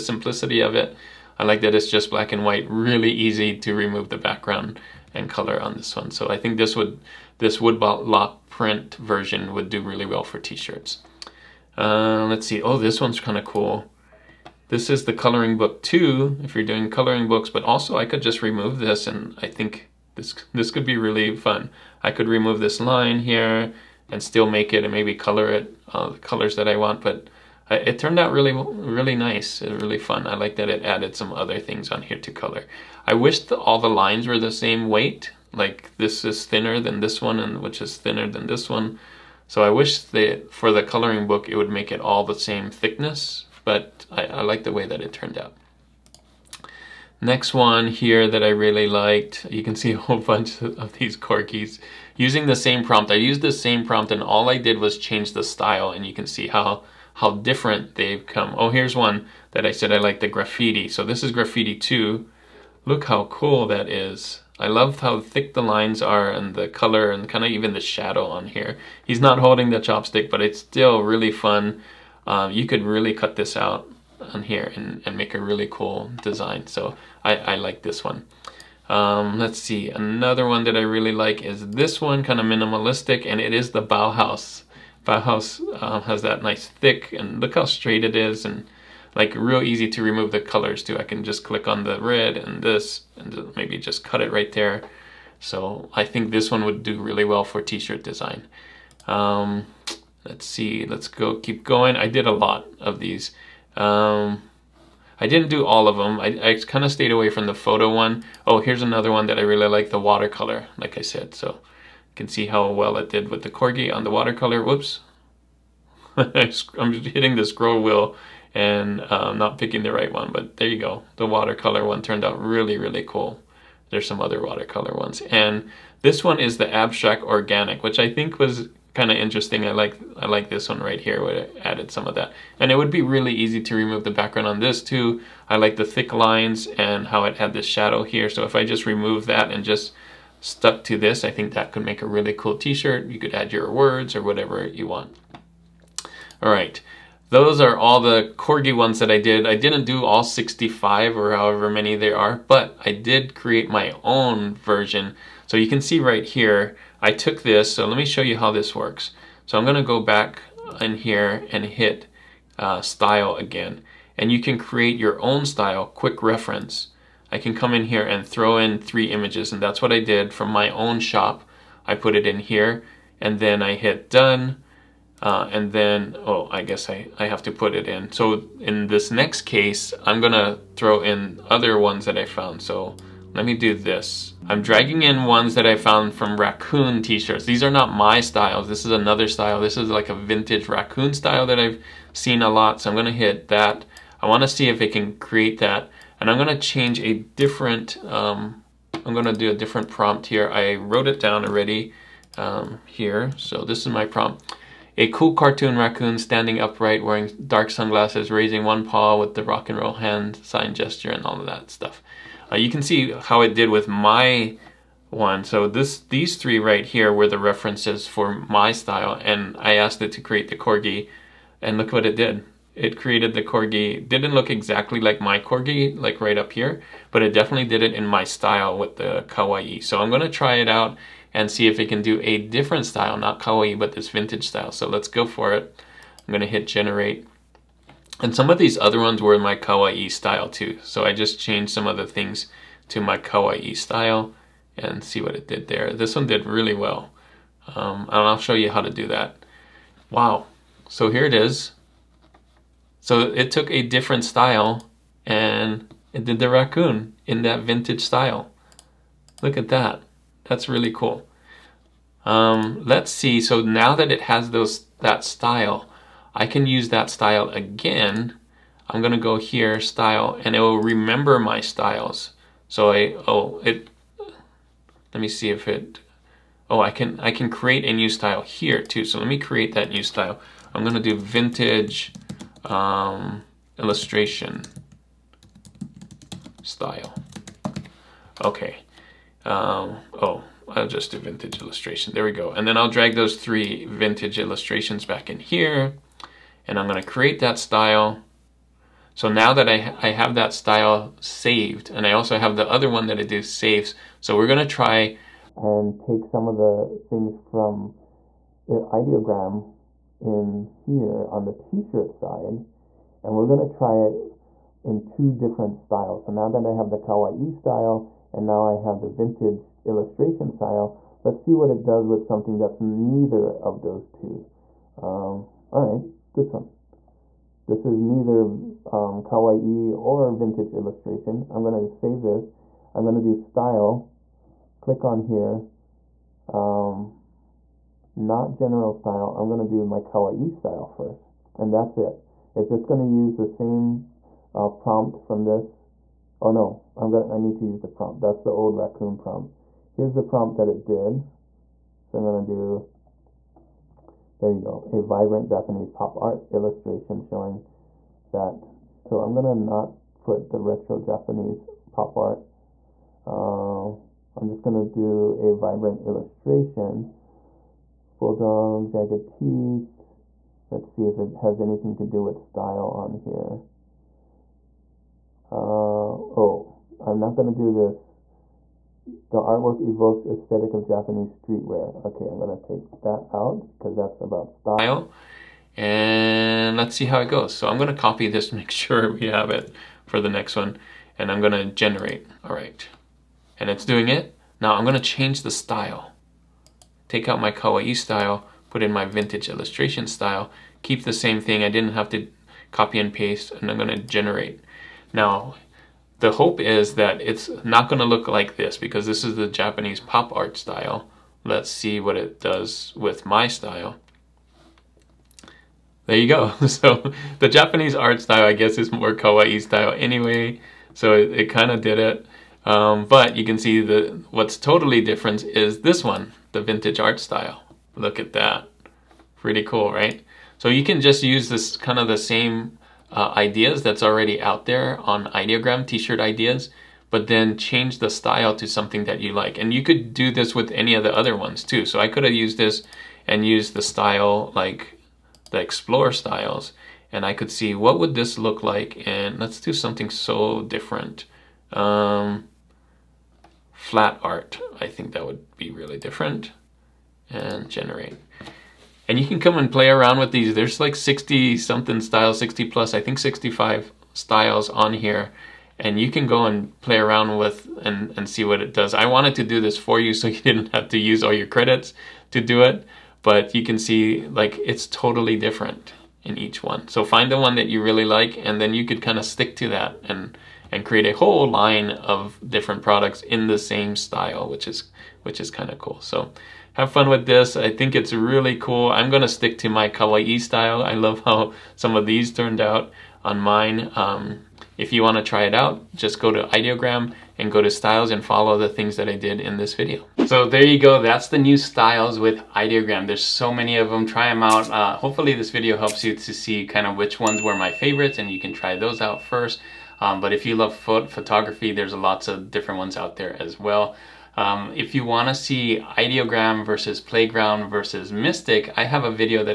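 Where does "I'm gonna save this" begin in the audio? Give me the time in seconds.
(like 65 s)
331 s.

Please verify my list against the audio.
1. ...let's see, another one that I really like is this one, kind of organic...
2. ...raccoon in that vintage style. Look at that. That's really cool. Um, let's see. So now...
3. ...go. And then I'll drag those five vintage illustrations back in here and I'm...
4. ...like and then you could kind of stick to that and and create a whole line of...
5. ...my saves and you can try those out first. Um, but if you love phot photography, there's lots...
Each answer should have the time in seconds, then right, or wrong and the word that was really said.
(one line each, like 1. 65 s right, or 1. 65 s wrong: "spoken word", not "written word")
1. 79 s wrong: "minimalistic", not "organic"
2. 256 s right
3. 292 s wrong: "three", not "five"
4. 478 s right
5. 507 s wrong: "favorites", not "saves".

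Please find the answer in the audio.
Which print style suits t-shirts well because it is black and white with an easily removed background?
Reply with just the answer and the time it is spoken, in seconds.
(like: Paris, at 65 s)
woodblock print, at 7 s.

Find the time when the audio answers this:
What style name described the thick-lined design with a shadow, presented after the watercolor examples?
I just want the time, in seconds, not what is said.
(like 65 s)
126 s.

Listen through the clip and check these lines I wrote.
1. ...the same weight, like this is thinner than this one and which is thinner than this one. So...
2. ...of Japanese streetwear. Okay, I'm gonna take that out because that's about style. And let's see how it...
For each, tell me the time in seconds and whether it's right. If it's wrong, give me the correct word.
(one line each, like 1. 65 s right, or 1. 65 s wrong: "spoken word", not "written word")
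1. 34 s right
2. 380 s right.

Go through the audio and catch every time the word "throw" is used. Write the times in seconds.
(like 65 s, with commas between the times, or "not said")
168 s, 180 s.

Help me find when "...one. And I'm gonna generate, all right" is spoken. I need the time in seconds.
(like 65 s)
390 s.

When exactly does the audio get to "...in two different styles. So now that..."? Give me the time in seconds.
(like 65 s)
314 s.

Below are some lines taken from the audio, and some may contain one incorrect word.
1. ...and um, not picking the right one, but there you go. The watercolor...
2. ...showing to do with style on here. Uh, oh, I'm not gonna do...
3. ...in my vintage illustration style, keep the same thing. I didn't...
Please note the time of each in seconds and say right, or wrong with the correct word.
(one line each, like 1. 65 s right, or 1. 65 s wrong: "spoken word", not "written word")
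1. 118 s right
2. 371 s wrong: "anything", not "showing"
3. 398 s right.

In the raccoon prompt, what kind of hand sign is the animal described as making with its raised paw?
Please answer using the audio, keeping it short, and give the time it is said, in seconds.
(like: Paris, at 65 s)
rock and roll, at 209 s.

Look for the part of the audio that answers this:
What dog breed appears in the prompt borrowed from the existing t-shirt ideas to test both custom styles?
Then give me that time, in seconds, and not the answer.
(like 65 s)
368 s.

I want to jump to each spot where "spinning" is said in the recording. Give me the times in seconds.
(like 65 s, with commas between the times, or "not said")
not said.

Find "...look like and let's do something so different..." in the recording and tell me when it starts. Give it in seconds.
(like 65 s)
448 s.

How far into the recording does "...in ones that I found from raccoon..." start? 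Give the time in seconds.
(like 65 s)
185 s.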